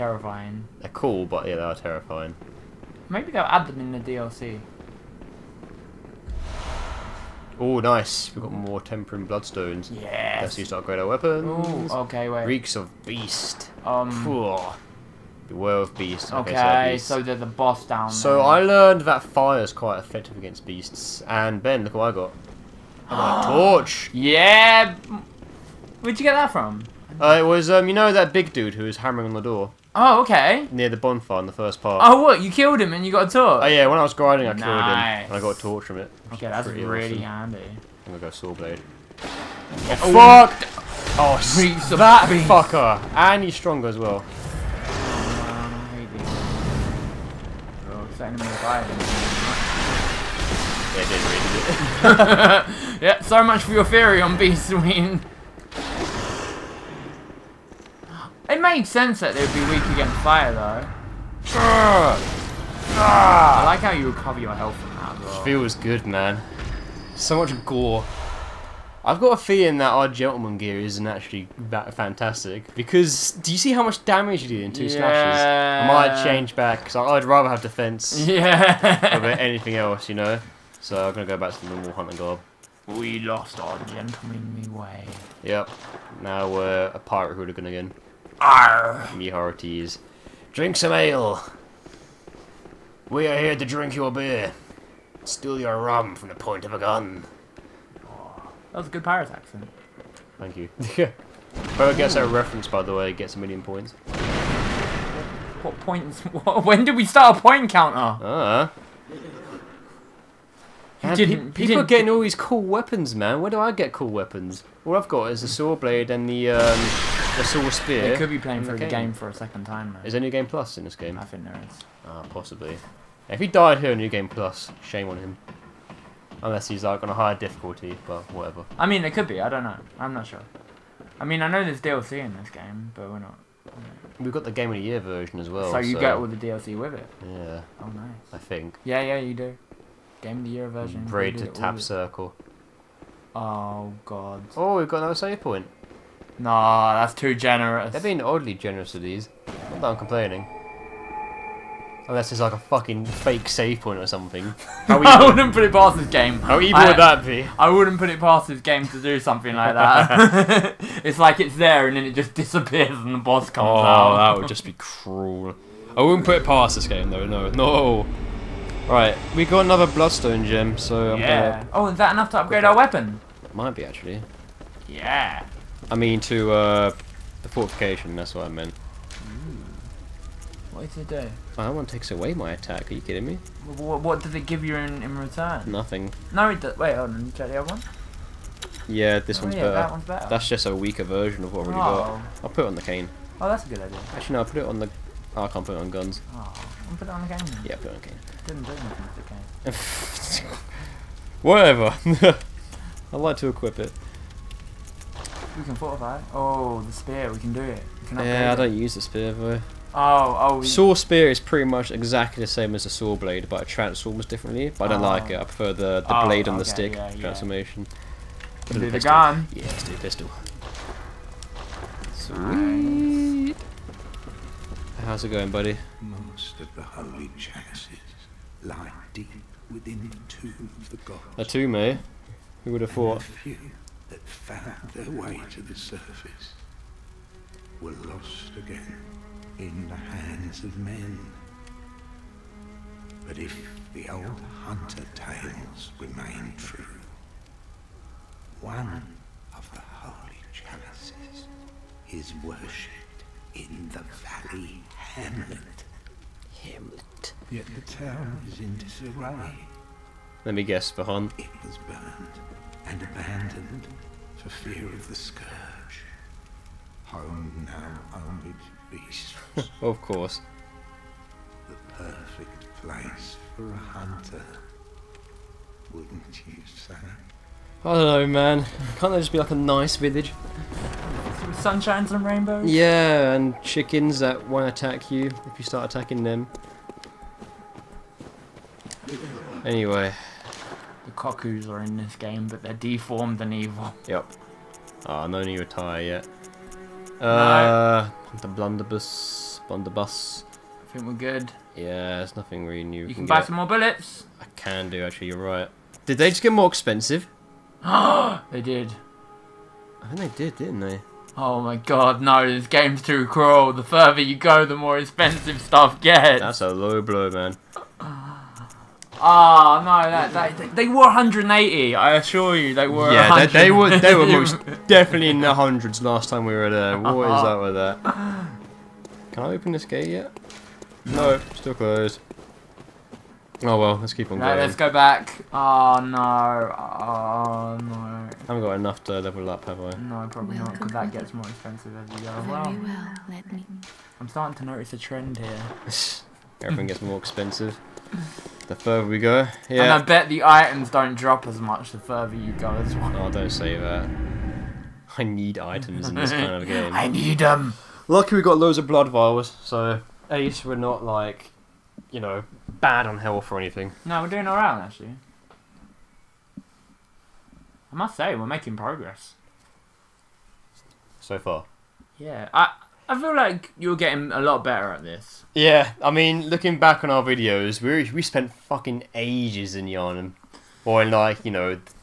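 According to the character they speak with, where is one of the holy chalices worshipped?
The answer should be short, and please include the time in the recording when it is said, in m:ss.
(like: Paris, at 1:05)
valley hamlet, at 4:14.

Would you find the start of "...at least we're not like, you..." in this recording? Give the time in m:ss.
6:00.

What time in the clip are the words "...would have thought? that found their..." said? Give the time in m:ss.
3:52.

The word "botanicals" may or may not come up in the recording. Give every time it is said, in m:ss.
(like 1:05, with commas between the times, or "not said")
not said.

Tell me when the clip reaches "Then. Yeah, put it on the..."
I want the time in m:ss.
3:17.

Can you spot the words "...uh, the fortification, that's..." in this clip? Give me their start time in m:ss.
2:56.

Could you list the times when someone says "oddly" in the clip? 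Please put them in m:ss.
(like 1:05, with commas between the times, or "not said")
2:28.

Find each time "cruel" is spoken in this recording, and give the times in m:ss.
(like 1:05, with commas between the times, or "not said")
2:44, 5:13.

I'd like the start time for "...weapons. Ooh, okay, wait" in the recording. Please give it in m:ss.
0:11.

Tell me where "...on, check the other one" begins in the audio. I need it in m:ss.
3:07.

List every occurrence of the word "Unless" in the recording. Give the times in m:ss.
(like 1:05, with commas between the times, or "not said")
2:06, 2:32.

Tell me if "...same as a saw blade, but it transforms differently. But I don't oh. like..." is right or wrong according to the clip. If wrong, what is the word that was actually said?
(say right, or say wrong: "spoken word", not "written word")
right.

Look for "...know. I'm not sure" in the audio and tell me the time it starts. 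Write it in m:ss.
2:09.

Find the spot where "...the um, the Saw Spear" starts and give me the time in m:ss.
1:56.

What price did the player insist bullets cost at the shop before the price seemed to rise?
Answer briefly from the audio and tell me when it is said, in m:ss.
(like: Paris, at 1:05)
180, at 5:20.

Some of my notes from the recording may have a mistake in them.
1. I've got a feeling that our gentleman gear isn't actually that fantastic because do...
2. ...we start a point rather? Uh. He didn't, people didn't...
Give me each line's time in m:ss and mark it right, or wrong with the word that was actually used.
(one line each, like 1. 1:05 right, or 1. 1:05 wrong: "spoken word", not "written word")
1. 1:09 right
2. 1:46 wrong: "counter", not "rather".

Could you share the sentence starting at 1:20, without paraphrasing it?
So I'm gonna go back to the normal hunting gob.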